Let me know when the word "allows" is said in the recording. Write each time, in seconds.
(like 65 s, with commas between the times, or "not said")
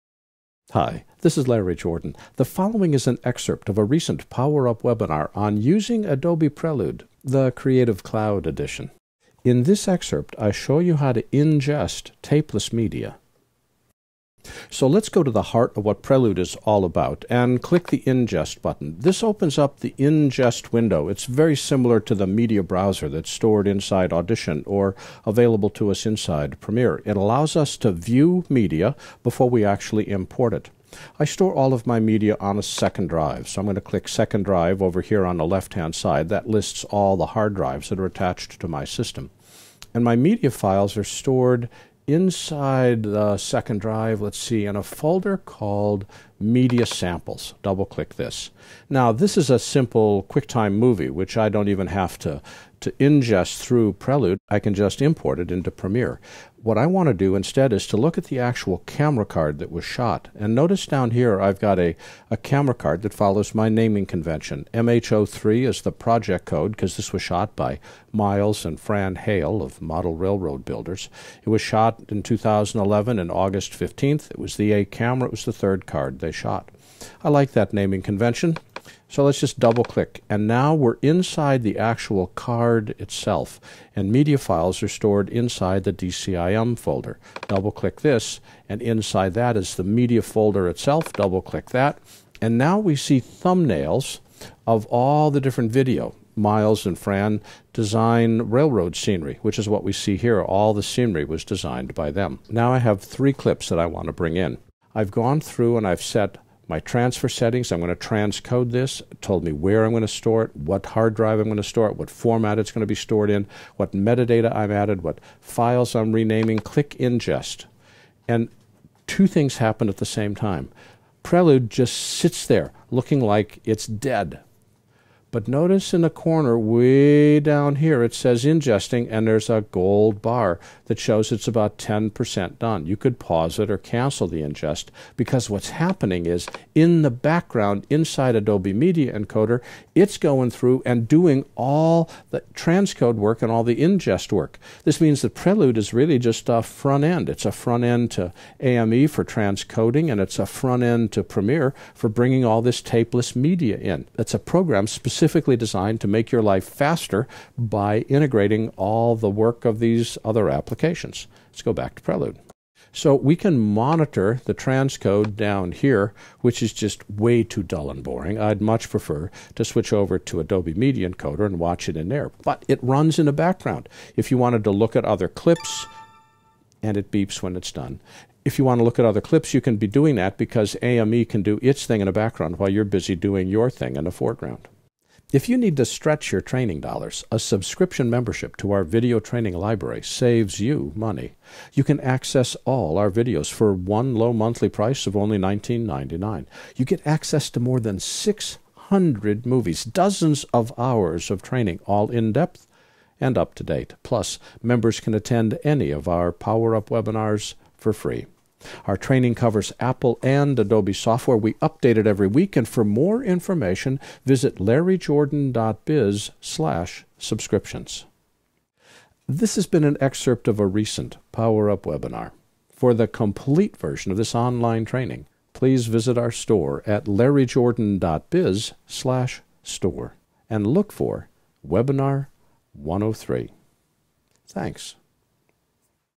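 27 s.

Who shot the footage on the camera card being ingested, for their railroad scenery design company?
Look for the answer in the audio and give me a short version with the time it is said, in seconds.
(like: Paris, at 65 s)
Miles and Fran Hale, at 68 s.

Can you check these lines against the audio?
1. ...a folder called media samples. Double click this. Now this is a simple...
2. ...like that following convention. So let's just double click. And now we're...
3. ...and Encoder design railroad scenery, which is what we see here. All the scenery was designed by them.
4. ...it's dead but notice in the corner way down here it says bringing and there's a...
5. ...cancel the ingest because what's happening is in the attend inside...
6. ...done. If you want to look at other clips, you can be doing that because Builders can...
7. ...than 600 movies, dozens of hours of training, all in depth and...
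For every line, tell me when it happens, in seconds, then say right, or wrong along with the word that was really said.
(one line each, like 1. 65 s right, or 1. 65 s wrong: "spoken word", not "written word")
1. 44 s right
2. 77 s wrong: "naming", not "following"
3. 96 s wrong: "Fran", not "Encoder"
4. 123 s wrong: "ingesting", not "bringing"
5. 133 s wrong: "background", not "attend"
6. 177 s wrong: "AME", not "Builders"
7. 197 s right.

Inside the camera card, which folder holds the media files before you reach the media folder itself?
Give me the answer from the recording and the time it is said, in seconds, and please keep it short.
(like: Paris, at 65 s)
DCIM, at 85 s.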